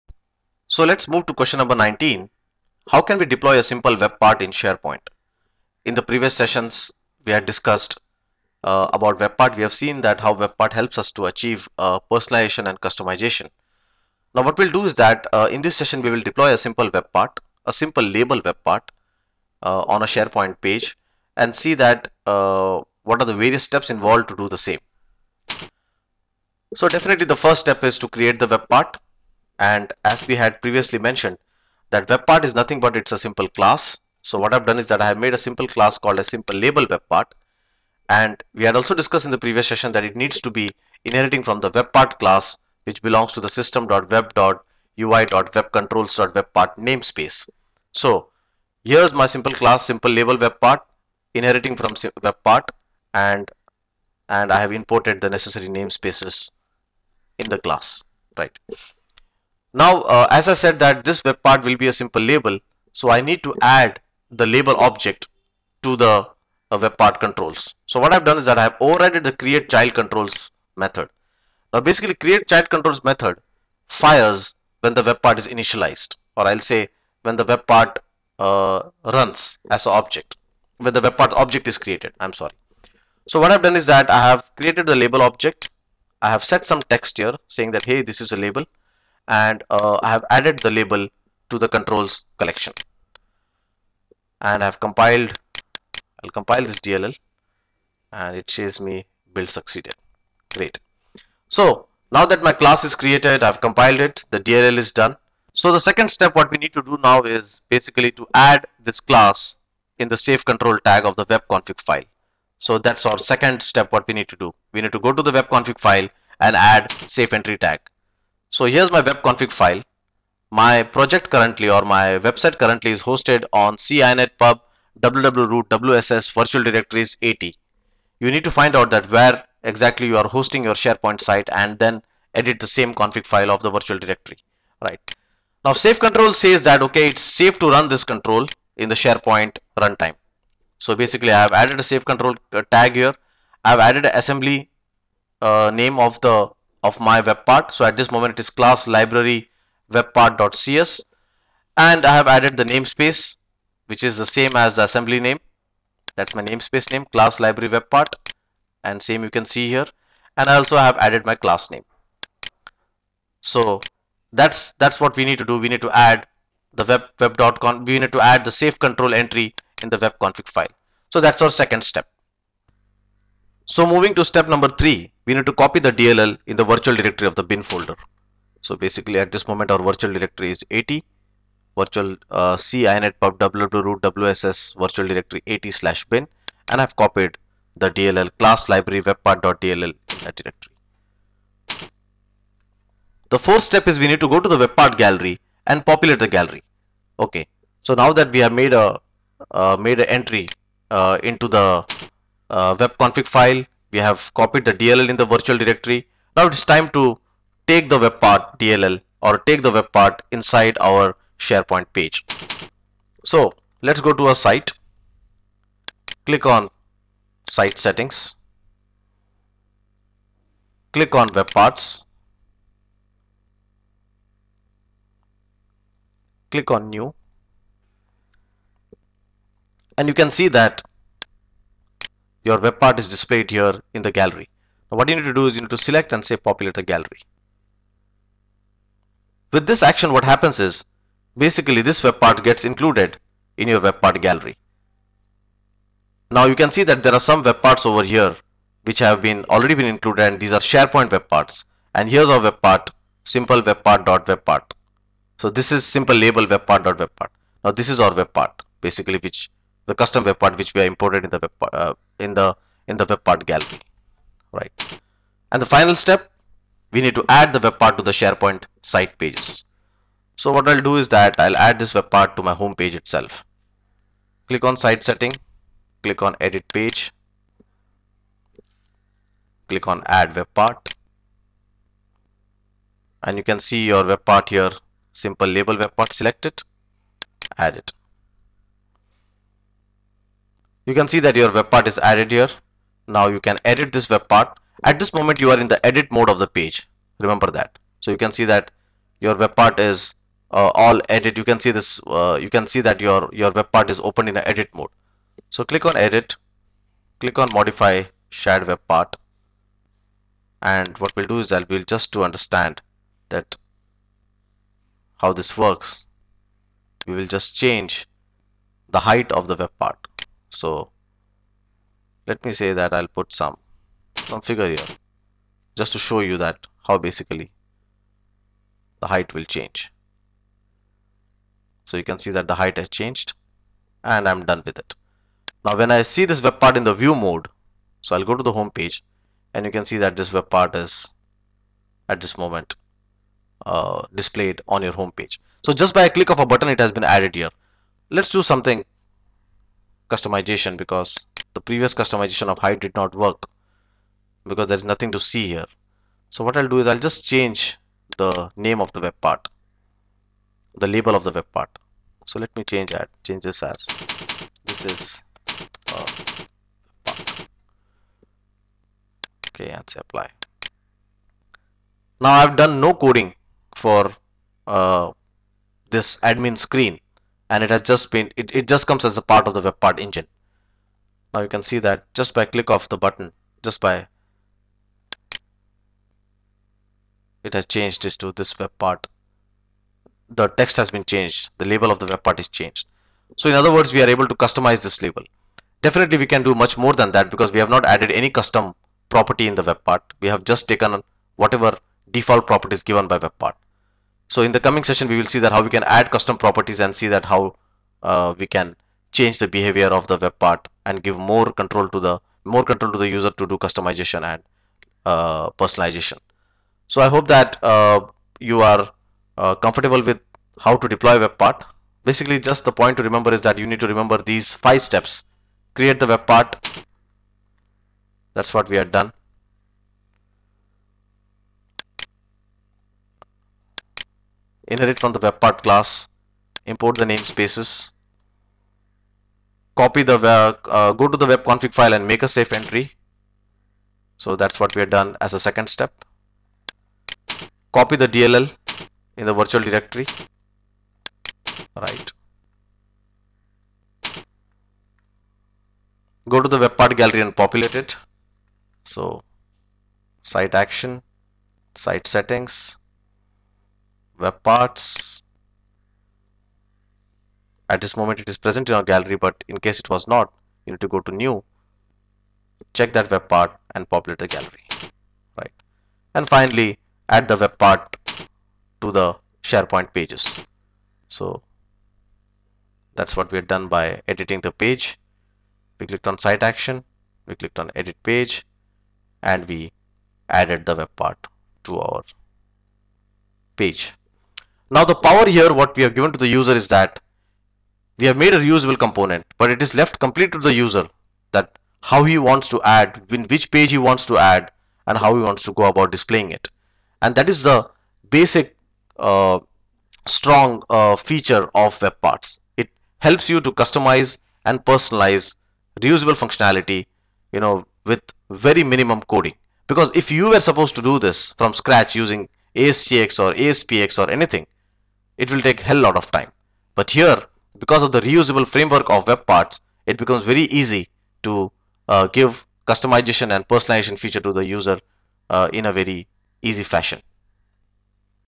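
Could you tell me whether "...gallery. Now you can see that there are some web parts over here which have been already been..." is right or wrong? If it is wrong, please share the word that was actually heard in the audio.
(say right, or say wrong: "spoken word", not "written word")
right.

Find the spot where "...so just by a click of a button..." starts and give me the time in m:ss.
5:45.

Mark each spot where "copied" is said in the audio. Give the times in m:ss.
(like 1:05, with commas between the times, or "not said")
3:06, 3:24.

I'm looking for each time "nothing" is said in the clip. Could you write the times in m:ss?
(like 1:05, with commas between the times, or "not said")
0:32, 5:54.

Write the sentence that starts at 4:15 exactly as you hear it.
So this is simple label web part dot web part.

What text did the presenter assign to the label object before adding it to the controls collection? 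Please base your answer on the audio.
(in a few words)
hey this is a label.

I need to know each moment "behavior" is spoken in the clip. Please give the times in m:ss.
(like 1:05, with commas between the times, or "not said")
6:49.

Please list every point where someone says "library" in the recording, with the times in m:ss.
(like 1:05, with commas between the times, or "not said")
2:28, 2:37, 3:08.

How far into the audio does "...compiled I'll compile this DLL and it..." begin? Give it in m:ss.
1:34.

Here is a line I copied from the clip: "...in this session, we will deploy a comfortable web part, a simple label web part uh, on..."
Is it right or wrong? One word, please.
wrong.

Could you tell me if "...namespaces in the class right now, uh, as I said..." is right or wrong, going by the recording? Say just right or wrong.
right.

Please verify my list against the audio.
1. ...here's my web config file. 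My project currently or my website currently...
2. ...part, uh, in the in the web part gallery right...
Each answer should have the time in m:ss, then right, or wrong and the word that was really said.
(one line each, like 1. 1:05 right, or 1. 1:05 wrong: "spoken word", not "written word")
1. 1:58 right
2. 4:21 right.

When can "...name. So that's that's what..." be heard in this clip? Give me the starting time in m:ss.
2:41.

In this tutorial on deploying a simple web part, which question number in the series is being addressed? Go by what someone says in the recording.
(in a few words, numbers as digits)
19.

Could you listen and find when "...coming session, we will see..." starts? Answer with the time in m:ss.
6:44.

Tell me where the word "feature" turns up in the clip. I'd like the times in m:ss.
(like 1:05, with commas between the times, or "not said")
8:30, 8:53.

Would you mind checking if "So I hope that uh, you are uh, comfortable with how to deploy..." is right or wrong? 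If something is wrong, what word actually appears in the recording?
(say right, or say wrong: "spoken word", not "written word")
right.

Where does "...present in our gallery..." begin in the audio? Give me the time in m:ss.
7:48.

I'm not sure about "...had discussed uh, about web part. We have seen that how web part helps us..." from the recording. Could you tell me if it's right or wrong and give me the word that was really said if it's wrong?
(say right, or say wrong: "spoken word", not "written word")
right.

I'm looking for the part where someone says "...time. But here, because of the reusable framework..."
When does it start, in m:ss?
8:46.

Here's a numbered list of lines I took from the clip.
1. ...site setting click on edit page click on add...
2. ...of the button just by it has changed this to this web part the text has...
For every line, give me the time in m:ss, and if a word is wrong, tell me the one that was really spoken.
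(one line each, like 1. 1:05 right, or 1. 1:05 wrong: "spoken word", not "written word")
1. 4:34 right
2. 6:22 right.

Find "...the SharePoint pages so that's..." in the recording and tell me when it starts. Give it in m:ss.
7:58.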